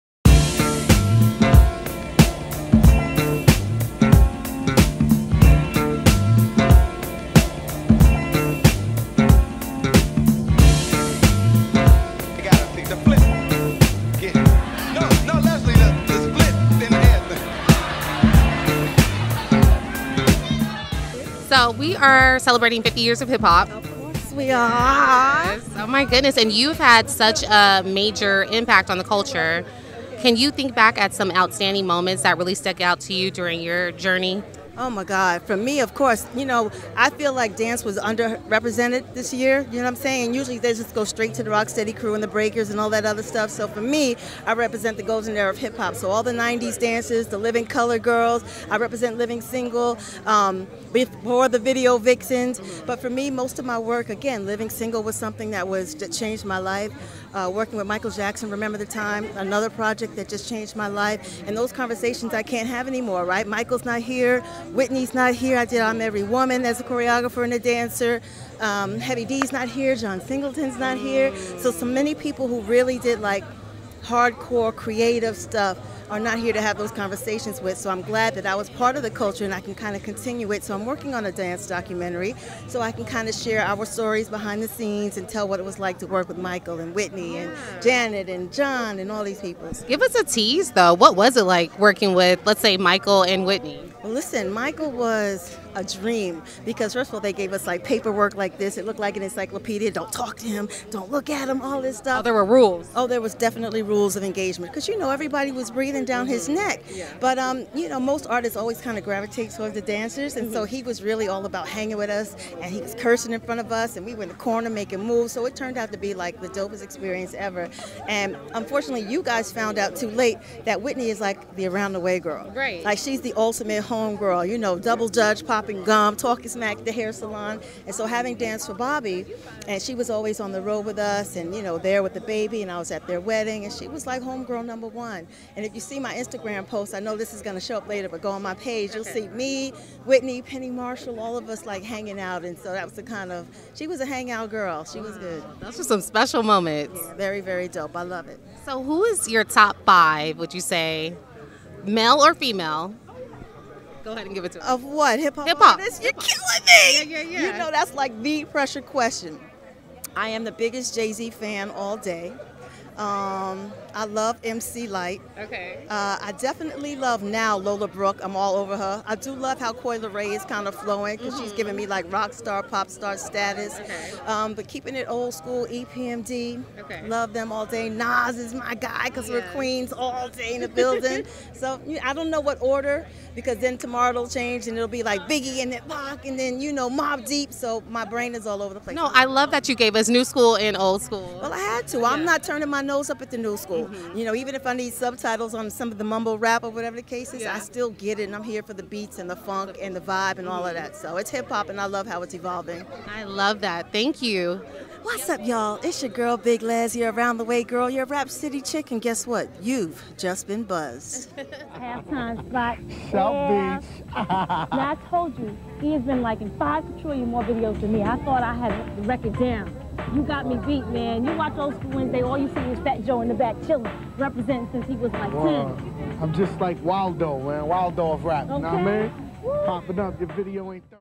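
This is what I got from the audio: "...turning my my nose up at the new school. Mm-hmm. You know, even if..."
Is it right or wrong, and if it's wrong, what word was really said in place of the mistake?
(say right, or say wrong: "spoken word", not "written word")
right.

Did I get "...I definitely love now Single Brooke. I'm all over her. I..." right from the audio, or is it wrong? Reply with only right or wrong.
wrong.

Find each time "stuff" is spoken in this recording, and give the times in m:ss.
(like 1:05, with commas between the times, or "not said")
0:43, 1:15, 1:41.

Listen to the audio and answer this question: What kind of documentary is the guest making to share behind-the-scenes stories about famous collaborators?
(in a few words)
Dance documentary.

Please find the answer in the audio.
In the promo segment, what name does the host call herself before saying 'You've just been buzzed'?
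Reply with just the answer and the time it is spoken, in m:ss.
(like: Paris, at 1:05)
Big Lez, at 3:26.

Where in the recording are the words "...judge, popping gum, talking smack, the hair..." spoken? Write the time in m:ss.
2:05.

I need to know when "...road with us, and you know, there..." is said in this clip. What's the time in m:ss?
2:10.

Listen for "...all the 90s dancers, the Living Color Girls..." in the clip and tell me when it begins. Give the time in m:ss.
0:46.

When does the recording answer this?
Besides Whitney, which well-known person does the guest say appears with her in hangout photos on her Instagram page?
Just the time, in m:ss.
2:20.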